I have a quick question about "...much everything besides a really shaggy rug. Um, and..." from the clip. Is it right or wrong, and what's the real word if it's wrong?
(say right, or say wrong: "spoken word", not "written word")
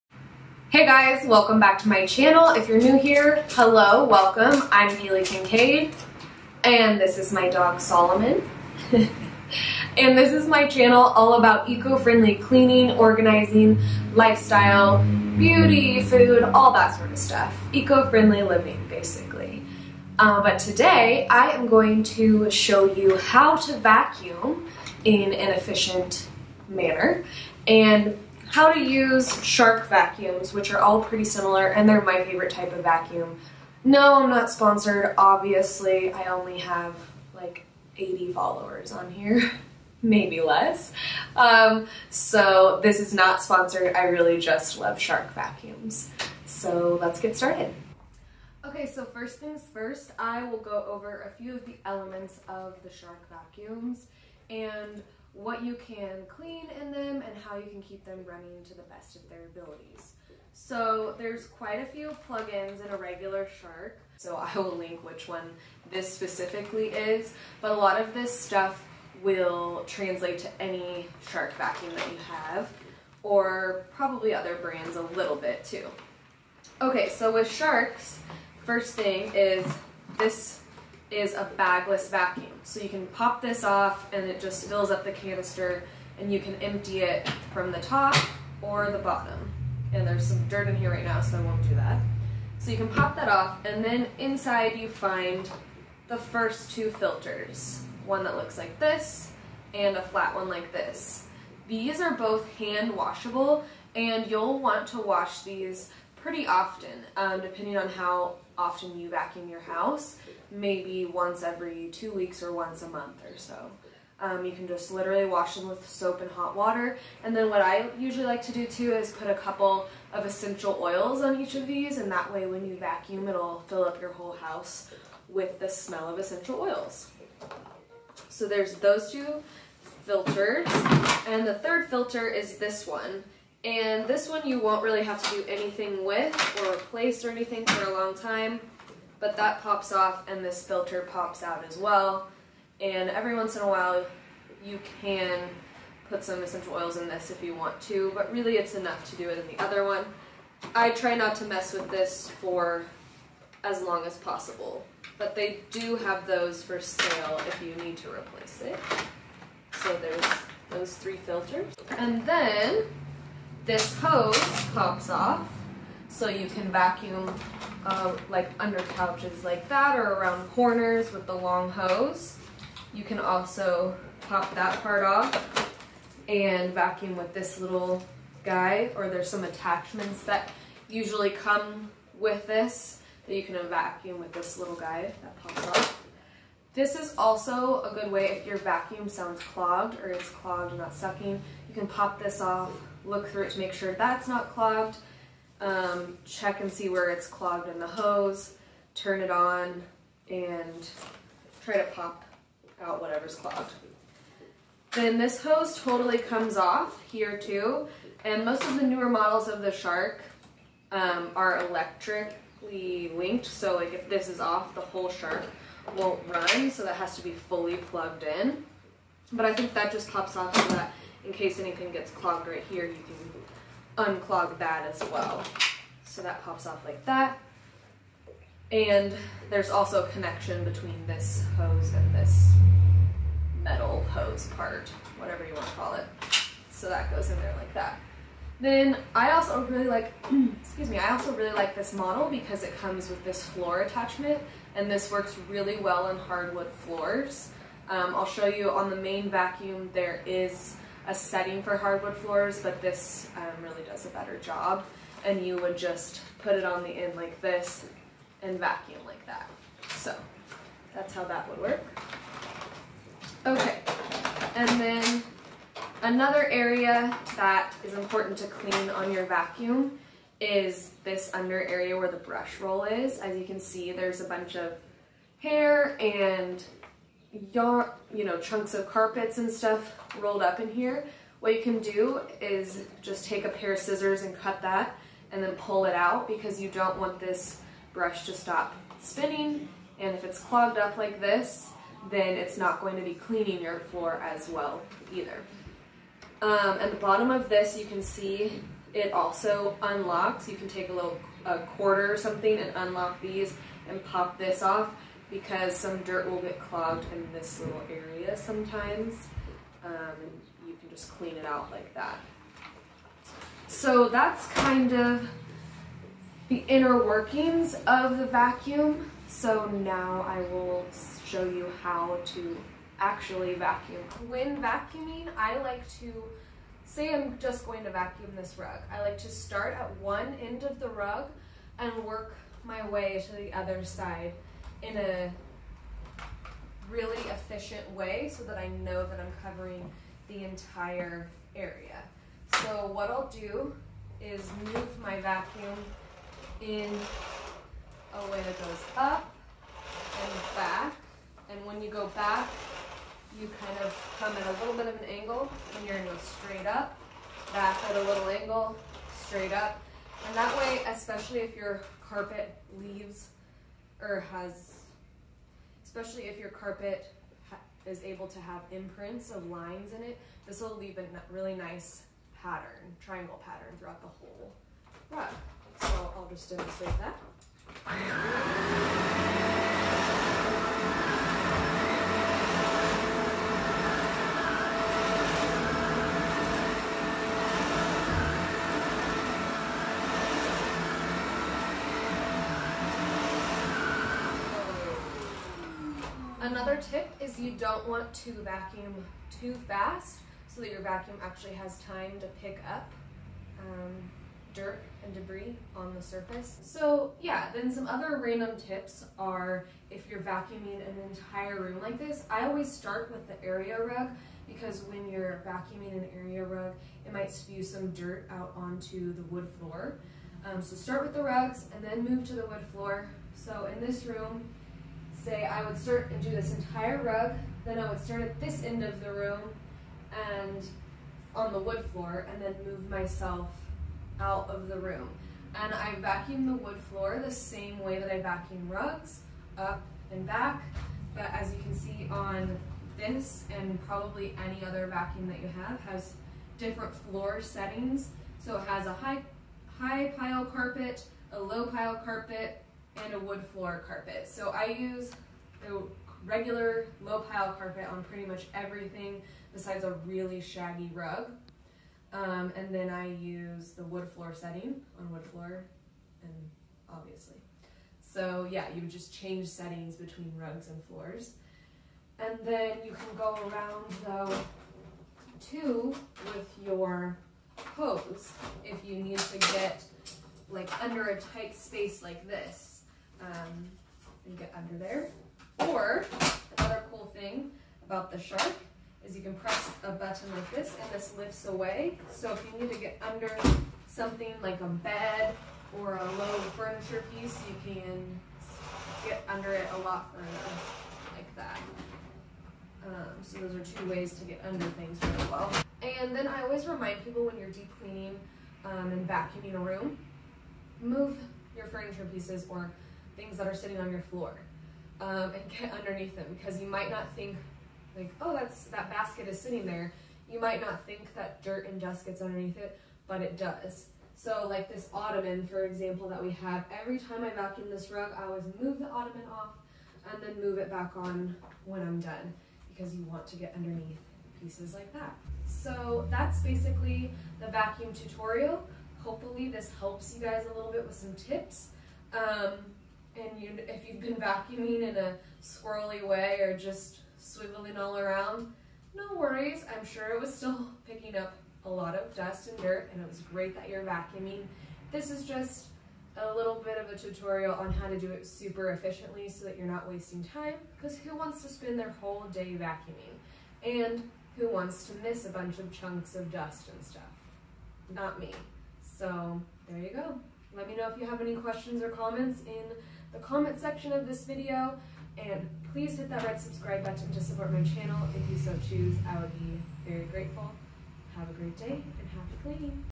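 right.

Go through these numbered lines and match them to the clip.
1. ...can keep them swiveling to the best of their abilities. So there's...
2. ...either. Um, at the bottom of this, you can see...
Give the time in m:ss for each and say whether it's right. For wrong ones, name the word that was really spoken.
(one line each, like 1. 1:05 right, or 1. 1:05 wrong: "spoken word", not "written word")
1. 0:57 wrong: "running", not "swiveling"
2. 4:55 right.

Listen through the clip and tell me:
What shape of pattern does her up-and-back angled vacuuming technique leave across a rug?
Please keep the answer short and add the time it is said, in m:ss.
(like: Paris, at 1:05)
triangle pattern, at 6:13.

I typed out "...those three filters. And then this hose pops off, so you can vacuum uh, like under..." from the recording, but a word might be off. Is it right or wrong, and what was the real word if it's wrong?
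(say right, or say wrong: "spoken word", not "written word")
right.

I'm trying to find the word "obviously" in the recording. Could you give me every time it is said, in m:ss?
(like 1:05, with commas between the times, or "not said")
0:35, 7:46.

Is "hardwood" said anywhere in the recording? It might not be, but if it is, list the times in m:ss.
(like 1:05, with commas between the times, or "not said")
4:06, 4:11.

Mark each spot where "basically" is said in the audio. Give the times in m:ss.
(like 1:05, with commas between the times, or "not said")
0:18, 8:56.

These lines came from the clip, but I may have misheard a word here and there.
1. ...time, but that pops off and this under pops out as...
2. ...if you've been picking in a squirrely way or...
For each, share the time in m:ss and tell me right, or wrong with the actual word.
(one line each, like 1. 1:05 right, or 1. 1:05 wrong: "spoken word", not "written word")
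1. 2:18 wrong: "filter", not "under"
2. 9:03 wrong: "vacuuming", not "picking".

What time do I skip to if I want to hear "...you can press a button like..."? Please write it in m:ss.
8:09.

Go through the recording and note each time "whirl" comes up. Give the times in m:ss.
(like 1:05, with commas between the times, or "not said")
not said.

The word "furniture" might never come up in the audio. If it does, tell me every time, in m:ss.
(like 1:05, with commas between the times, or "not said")
8:16, 8:31.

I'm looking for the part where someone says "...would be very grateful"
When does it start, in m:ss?
9:39.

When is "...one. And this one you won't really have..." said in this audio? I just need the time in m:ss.
2:12.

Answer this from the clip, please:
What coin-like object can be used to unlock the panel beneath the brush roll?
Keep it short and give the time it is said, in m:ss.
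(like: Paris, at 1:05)
a quarter, at 5:01.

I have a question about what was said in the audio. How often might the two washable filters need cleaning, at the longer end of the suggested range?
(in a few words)
once a month.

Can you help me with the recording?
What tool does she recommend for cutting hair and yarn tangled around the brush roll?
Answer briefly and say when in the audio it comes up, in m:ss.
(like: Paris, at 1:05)
scissors, at 4:43.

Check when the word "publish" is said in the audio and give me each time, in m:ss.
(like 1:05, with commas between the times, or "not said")
not said.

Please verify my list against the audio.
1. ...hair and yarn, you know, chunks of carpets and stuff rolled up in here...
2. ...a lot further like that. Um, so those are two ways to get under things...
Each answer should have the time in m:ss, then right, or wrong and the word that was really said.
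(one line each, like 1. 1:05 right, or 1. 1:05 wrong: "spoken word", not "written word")
1. 4:35 right
2. 8:19 right.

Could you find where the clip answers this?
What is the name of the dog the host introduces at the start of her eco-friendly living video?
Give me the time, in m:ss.
0:07.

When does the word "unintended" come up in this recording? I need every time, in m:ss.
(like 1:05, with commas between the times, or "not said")
not said.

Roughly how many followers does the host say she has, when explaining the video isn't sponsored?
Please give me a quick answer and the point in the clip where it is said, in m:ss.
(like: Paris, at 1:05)
80, at 0:37.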